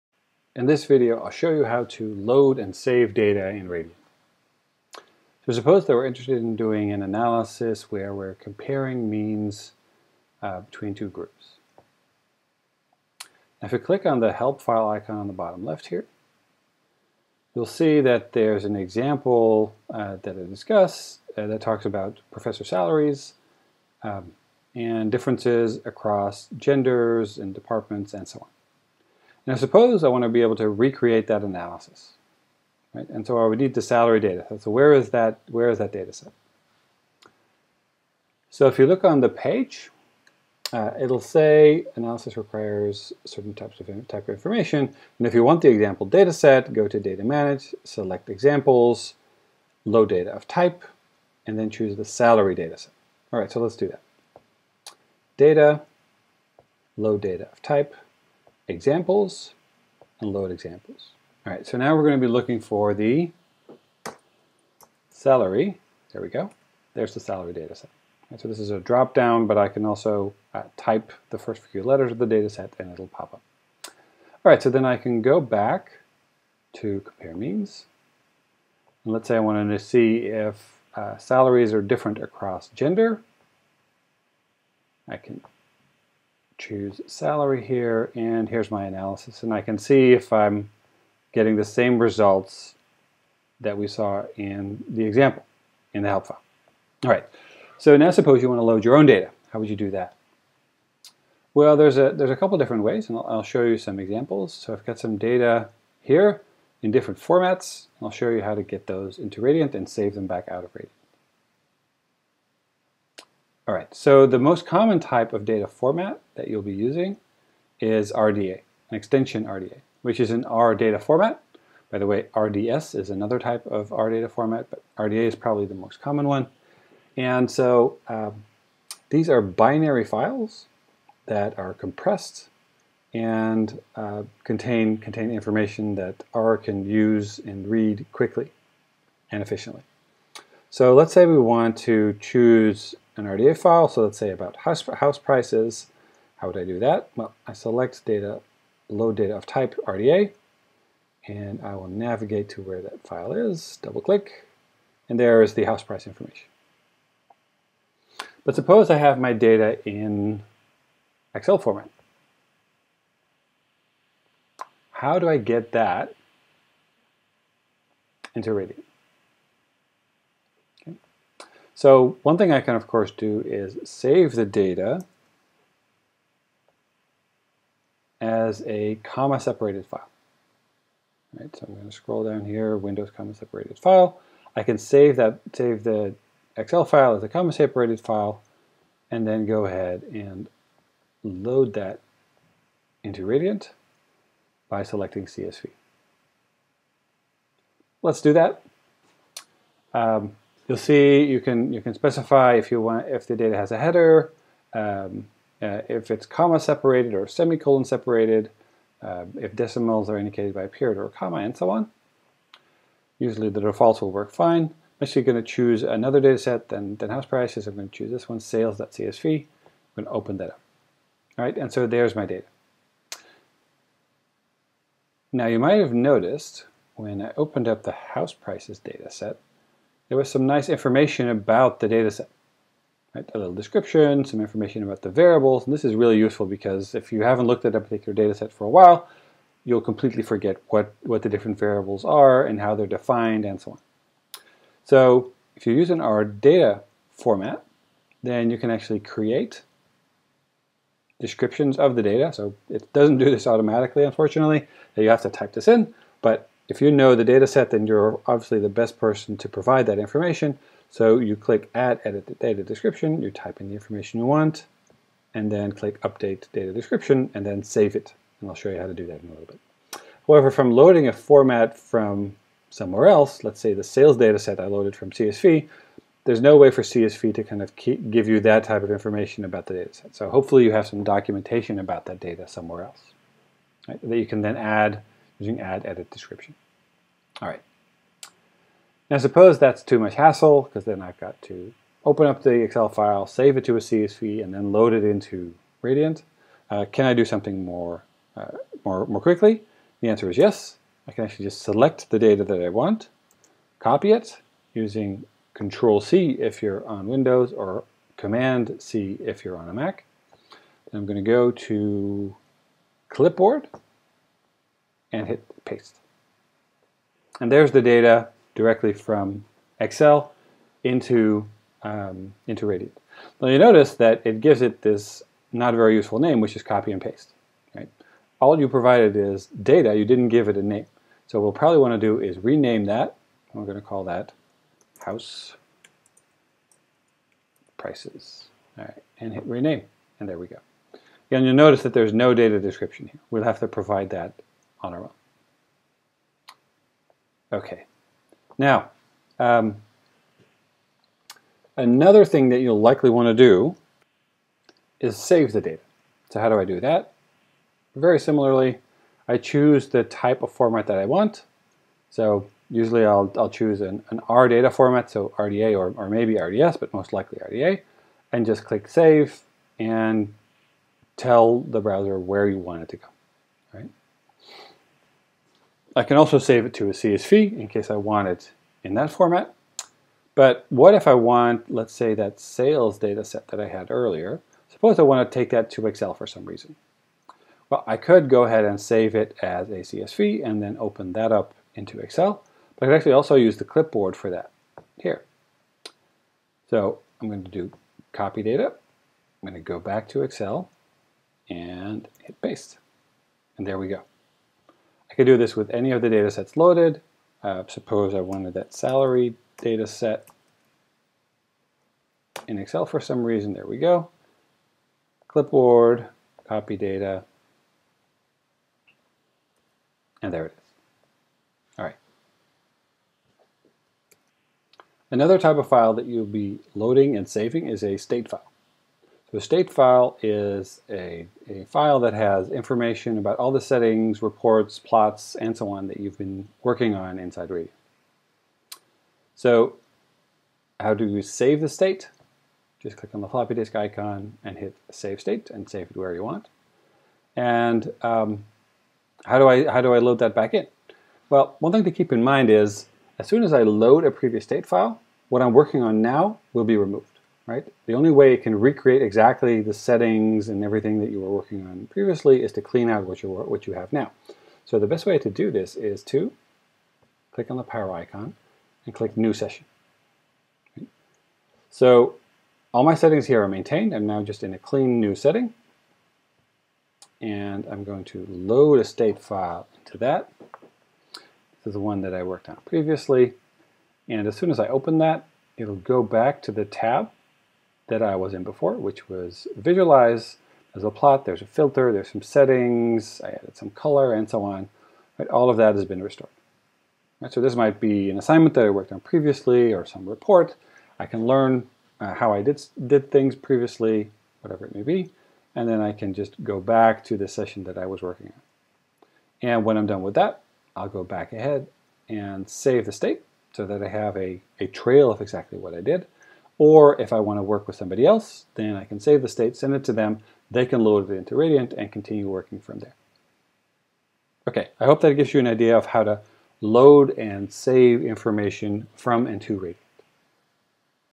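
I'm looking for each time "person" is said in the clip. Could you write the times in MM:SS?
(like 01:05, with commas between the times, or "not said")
04:18.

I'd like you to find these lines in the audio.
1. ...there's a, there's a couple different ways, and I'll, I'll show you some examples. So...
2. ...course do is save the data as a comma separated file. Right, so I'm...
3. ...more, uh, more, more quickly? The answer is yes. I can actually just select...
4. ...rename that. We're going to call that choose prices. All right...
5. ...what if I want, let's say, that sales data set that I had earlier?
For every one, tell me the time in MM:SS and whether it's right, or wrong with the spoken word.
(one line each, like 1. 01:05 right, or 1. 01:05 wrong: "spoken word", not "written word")
1. 01:41 right
2. 02:52 right
3. 04:57 right
4. 05:32 wrong: "house", not "choose"
5. 06:20 right.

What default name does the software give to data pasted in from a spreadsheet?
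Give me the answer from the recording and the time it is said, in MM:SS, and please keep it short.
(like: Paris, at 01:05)
copy and paste, at 05:26.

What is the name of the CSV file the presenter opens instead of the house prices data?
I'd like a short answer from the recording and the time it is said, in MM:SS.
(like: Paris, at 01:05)
sales.csv, at 03:38.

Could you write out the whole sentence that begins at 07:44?
So the best way to do this is to click on the power icon and click New Session.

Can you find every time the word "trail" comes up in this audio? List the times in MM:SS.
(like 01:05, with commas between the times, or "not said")
08:34.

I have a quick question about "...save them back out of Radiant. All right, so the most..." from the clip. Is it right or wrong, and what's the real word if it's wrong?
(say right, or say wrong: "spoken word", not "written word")
right.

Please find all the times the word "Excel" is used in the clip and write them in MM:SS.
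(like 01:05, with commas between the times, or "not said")
02:41, 03:06, 04:52, 05:19, 06:25, 06:31, 06:40, 06:52.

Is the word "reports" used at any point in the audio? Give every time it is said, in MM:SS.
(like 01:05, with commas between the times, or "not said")
07:14, 08:20.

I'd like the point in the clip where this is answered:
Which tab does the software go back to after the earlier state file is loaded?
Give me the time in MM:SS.
08:09.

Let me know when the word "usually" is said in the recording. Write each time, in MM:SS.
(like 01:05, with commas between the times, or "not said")
03:33, 06:02.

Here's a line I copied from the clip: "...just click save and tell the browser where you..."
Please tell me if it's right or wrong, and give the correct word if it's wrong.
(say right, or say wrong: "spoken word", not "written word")
right.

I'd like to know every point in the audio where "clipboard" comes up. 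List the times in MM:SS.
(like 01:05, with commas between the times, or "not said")
05:13, 06:33, 06:55.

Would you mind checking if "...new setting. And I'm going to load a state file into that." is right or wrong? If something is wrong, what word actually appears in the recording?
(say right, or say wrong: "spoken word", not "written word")
right.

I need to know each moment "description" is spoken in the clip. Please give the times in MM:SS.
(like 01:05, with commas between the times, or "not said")
03:53, 04:11, 04:22, 04:26, 04:46, 05:42.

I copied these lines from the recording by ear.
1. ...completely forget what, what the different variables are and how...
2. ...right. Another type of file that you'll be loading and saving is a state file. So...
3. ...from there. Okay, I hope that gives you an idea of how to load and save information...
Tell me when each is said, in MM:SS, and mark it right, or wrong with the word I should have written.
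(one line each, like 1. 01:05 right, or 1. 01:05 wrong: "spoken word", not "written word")
1. 03:59 right
2. 07:01 right
3. 08:42 right.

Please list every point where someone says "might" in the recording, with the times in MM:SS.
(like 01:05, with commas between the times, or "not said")
03:45, 08:17.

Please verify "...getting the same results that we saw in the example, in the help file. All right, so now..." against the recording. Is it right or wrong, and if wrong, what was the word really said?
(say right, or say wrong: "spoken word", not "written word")
right.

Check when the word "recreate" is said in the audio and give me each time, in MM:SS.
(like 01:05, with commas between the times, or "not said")
00:30, 07:38.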